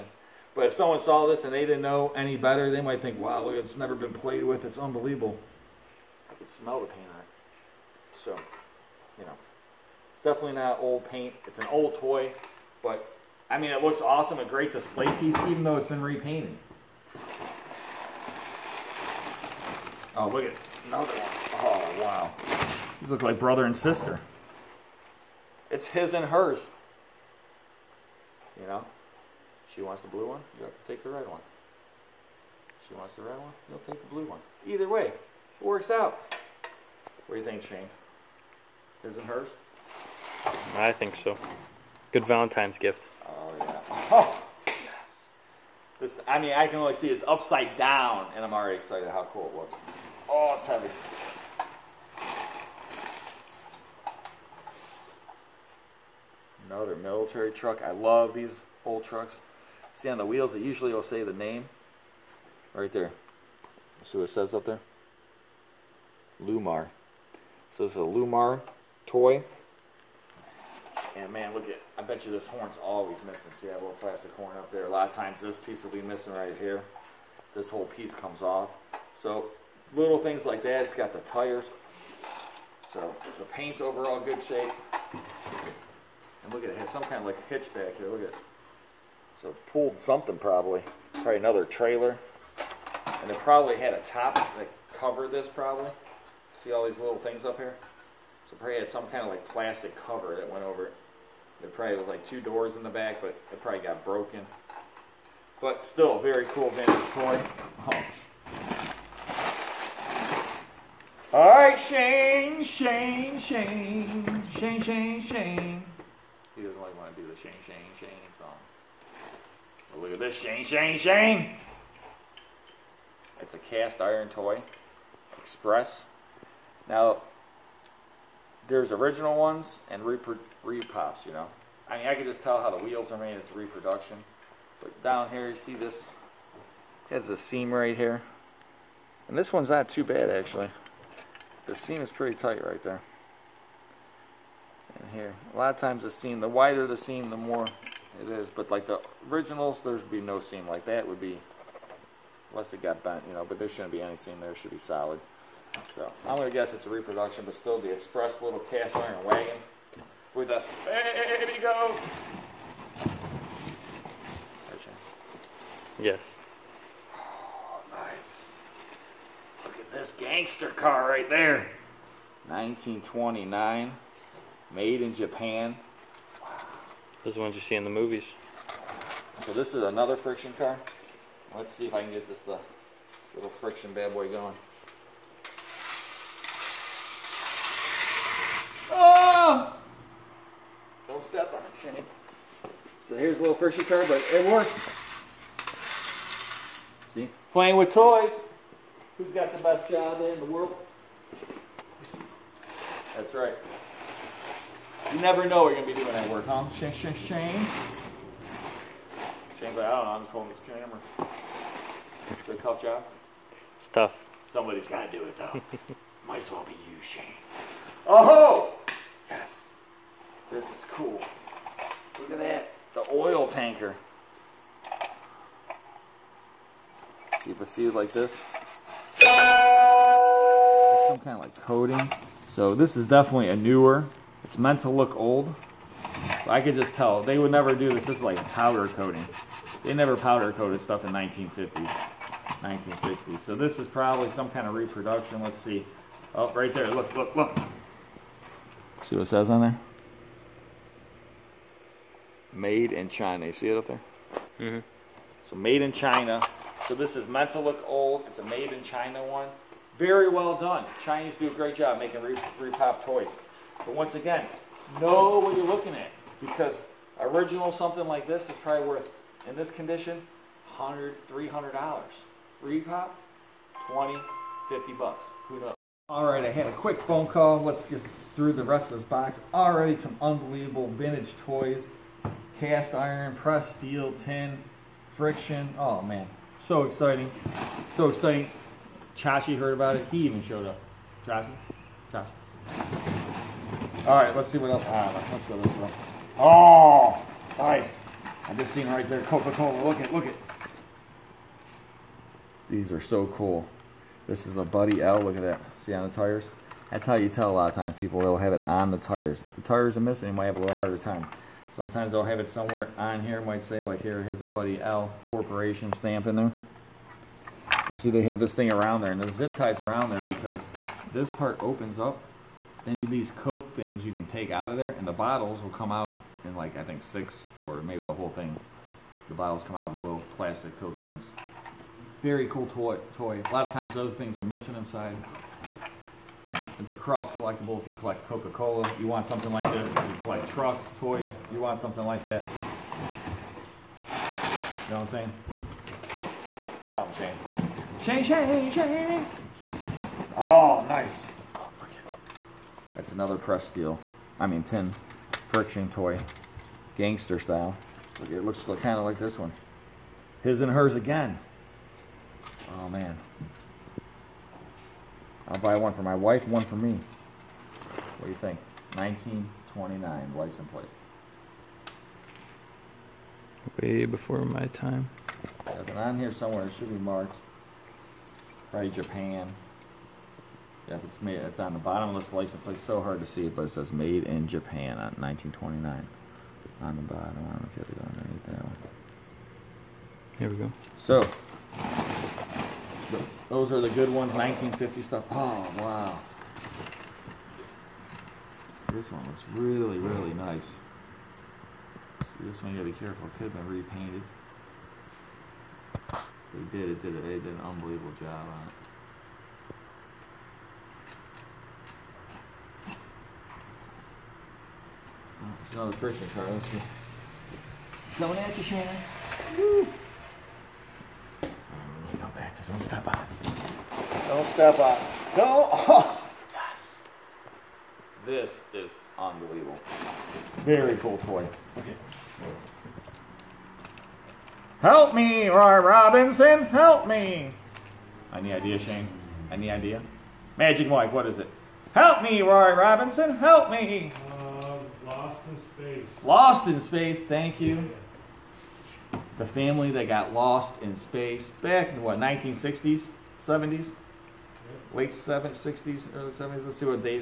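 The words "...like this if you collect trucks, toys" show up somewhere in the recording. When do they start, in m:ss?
5:39.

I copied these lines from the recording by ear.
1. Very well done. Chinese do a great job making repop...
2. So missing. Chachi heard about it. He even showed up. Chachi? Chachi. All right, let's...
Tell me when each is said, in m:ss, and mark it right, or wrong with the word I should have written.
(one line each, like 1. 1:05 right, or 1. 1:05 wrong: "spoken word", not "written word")
1. 4:19 right
2. 4:47 wrong: "exciting", not "missing".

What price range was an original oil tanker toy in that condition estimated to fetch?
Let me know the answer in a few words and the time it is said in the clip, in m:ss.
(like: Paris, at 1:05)
$100 to $300, at 4:30.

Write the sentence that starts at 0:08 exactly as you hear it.
So, you know, it's definitely not old paint.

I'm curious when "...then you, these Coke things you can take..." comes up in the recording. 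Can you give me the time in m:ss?
5:22.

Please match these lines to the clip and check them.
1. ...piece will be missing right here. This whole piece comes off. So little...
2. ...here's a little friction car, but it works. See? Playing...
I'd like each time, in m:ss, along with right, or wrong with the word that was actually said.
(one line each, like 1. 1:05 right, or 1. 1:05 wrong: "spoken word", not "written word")
1. 1:15 right
2. 3:13 right.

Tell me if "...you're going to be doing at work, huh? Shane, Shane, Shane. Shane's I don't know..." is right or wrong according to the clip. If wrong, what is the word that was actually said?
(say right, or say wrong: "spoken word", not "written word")
right.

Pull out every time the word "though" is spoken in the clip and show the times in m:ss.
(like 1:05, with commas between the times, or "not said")
0:15, 3:35.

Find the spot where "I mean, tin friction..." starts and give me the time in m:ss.
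5:54.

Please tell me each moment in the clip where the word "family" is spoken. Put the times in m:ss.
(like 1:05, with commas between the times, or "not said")
7:29.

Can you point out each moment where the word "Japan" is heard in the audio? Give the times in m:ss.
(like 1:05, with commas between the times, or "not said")
2:55, 6:18, 6:24.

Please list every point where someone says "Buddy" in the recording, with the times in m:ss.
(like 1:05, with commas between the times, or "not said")
5:04, 5:14.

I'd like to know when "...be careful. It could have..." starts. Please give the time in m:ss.
6:42.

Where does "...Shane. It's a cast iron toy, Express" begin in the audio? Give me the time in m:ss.
2:00.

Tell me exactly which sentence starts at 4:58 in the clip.
I just seen right there Coca-Cola.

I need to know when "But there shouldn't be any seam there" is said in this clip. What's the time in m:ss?
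2:33.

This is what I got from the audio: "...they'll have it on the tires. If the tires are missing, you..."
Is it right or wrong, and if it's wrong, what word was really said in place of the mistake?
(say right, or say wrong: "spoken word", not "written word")
right.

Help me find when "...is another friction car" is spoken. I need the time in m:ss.
2:59.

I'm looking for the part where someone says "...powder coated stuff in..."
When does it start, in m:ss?
4:00.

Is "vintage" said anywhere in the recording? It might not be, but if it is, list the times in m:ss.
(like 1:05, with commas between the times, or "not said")
1:46, 4:40.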